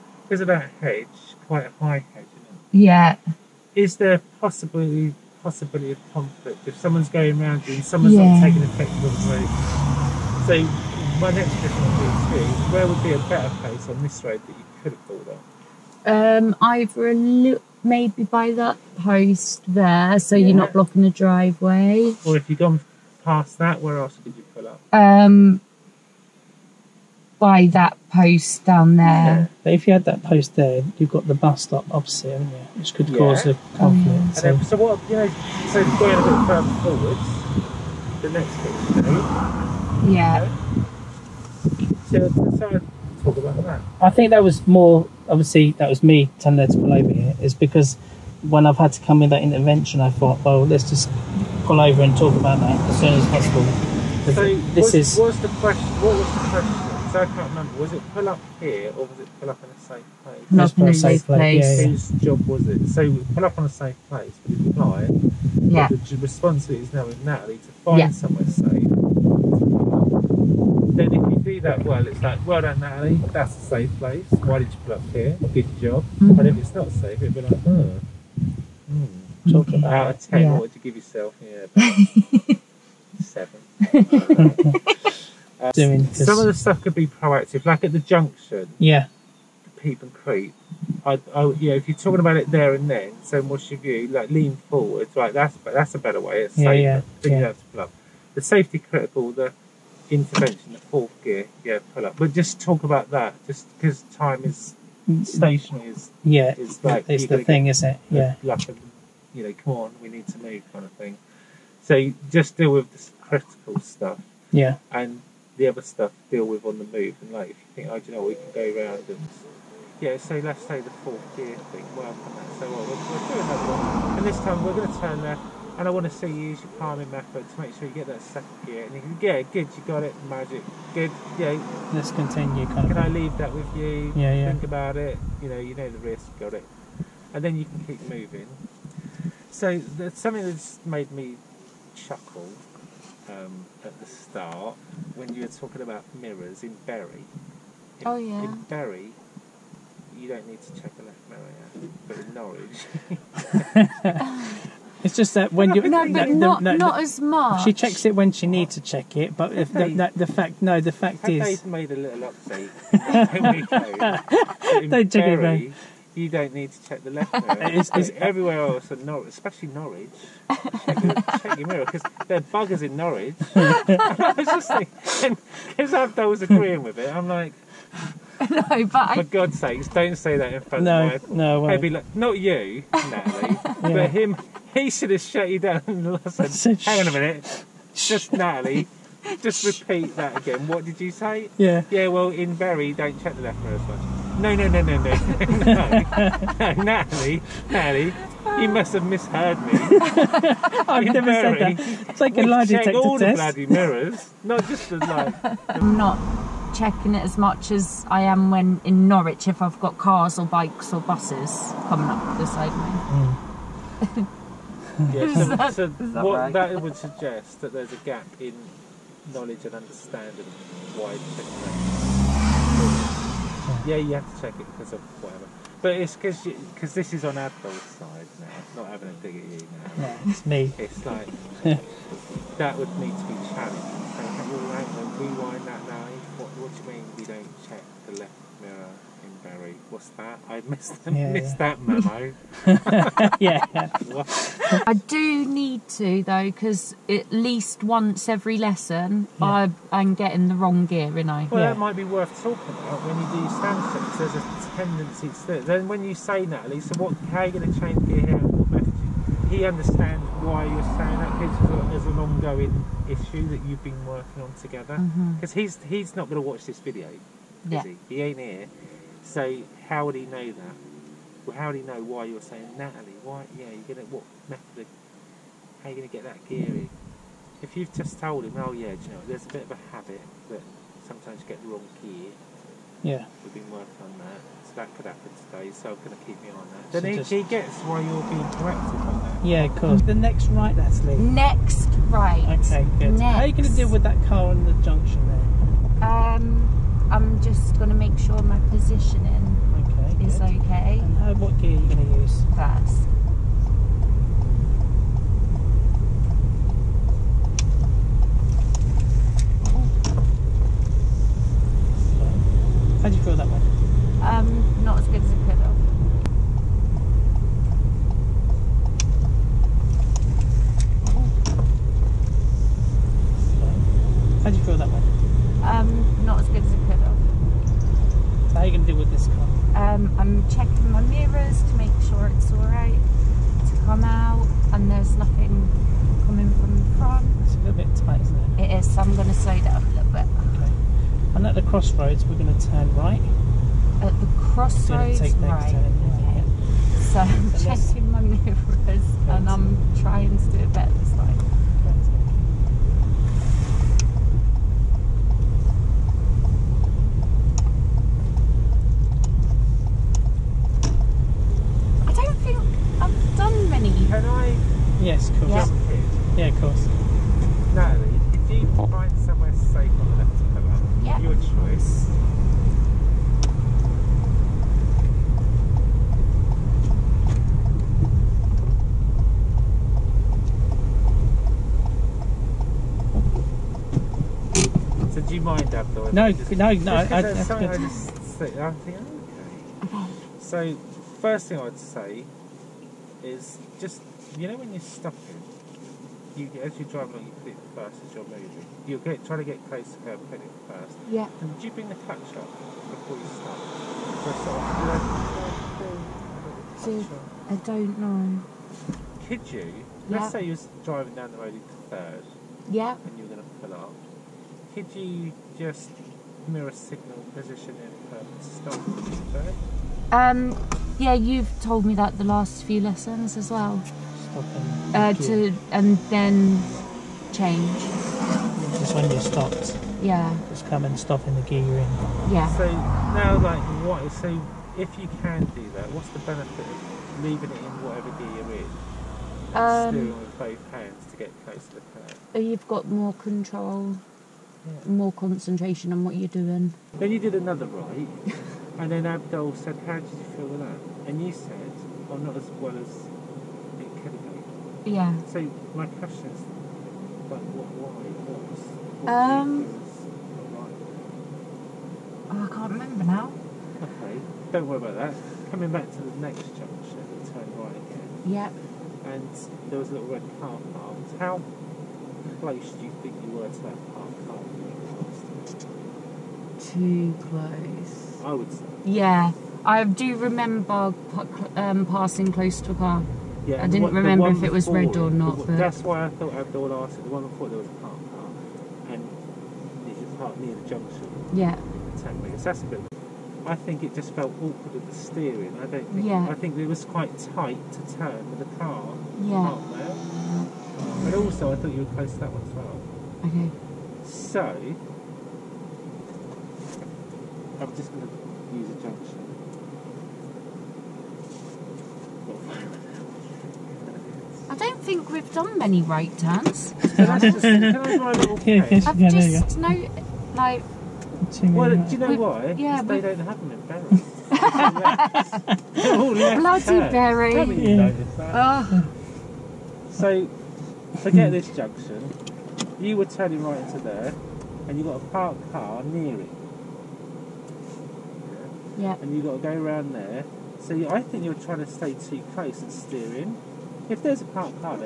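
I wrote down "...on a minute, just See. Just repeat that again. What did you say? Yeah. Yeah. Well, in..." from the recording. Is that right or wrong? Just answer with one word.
wrong.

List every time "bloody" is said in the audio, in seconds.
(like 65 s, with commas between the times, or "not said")
203 s, 526 s.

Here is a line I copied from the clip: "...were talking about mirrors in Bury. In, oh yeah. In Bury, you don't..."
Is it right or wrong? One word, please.
right.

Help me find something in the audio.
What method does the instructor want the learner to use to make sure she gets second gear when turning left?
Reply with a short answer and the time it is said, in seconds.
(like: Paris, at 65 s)
Palming method, at 126 s.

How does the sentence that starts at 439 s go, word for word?
Um, steering with both hands to get close to the curb.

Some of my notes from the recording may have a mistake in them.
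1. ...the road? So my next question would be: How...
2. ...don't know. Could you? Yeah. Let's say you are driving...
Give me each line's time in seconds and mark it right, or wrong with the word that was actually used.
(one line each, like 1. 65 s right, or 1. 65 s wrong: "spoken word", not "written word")
1. 9 s wrong: "Where", not "How"
2. 407 s right.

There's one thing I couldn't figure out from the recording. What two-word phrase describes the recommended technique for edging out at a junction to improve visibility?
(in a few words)
Peep and creep.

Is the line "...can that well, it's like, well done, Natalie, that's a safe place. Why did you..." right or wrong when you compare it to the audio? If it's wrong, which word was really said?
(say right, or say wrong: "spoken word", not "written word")
right.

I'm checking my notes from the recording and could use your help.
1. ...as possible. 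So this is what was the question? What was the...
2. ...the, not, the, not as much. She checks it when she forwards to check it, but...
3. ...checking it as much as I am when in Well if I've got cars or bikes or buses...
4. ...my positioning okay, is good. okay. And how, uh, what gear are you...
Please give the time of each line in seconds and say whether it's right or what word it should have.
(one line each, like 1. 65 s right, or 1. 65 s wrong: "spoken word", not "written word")
1. 53 s right
2. 156 s wrong: "needs", not "forwards"
3. 206 s wrong: "Norwich", not "Well"
4. 298 s right.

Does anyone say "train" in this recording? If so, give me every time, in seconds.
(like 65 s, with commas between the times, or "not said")
not said.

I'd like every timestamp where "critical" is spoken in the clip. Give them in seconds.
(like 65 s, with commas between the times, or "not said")
98 s, 113 s.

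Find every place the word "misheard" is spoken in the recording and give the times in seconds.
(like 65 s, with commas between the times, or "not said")
199 s.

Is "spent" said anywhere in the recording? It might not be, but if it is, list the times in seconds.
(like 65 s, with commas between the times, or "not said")
not said.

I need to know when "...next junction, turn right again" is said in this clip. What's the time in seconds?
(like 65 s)
466 s.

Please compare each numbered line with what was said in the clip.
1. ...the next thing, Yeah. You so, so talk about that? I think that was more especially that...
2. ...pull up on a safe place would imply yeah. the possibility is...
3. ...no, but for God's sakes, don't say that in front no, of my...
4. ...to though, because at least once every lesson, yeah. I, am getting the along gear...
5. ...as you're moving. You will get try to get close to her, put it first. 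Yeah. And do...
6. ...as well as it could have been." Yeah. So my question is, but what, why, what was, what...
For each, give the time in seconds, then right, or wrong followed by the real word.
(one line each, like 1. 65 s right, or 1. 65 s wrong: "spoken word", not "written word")
1. 38 s wrong: "obviously", not "especially"
2. 63 s wrong: "responsibility", not "possibility"
3. 178 s right
4. 245 s wrong: "wrong", not "along"
5. 398 s right
6. 452 s right.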